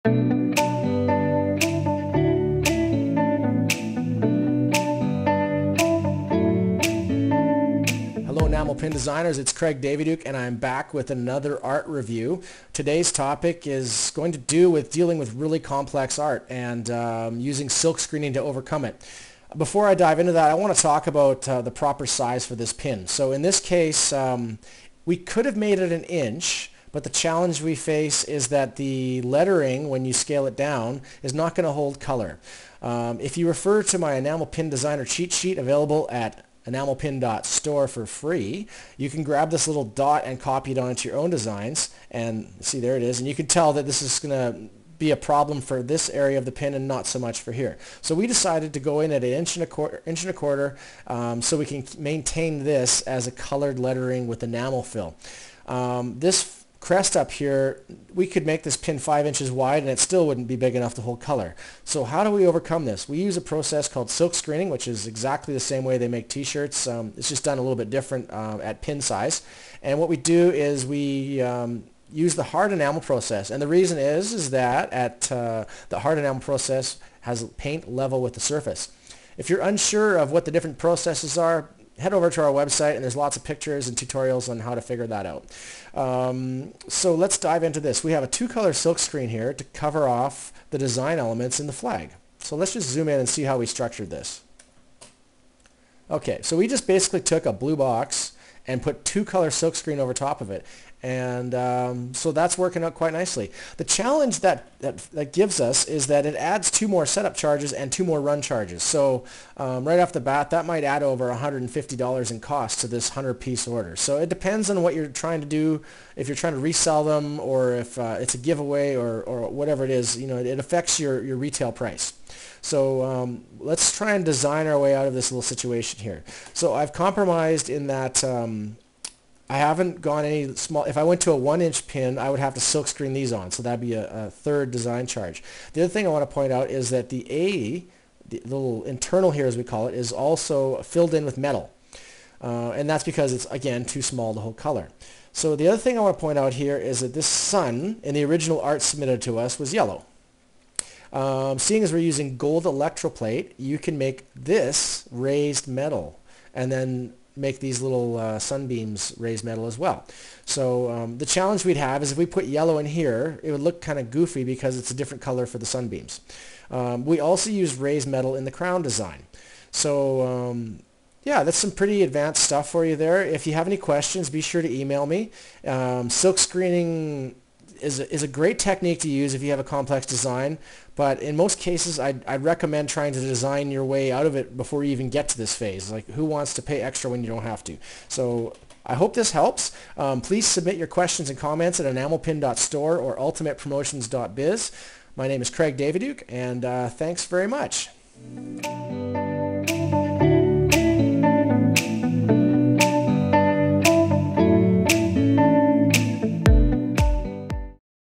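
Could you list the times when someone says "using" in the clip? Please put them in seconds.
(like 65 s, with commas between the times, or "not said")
17 s, 151 s.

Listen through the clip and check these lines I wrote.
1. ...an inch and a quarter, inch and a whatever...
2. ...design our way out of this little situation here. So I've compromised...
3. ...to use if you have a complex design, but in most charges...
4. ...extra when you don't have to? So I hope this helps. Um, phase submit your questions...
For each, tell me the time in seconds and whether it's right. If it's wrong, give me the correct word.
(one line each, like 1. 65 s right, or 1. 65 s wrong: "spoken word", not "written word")
1. 49 s wrong: "quarter", not "whatever"
2. 124 s right
3. 179 s wrong: "cases", not "charges"
4. 186 s wrong: "please", not "phase".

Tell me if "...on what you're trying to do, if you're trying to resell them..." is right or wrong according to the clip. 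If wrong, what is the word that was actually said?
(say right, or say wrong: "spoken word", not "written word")
right.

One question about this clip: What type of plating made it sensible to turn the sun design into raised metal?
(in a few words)
Gold electroplate.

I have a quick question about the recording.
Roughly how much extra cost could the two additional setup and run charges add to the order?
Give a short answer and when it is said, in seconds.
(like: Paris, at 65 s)
Over $150, at 111 s.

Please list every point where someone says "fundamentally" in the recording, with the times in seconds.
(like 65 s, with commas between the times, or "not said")
not said.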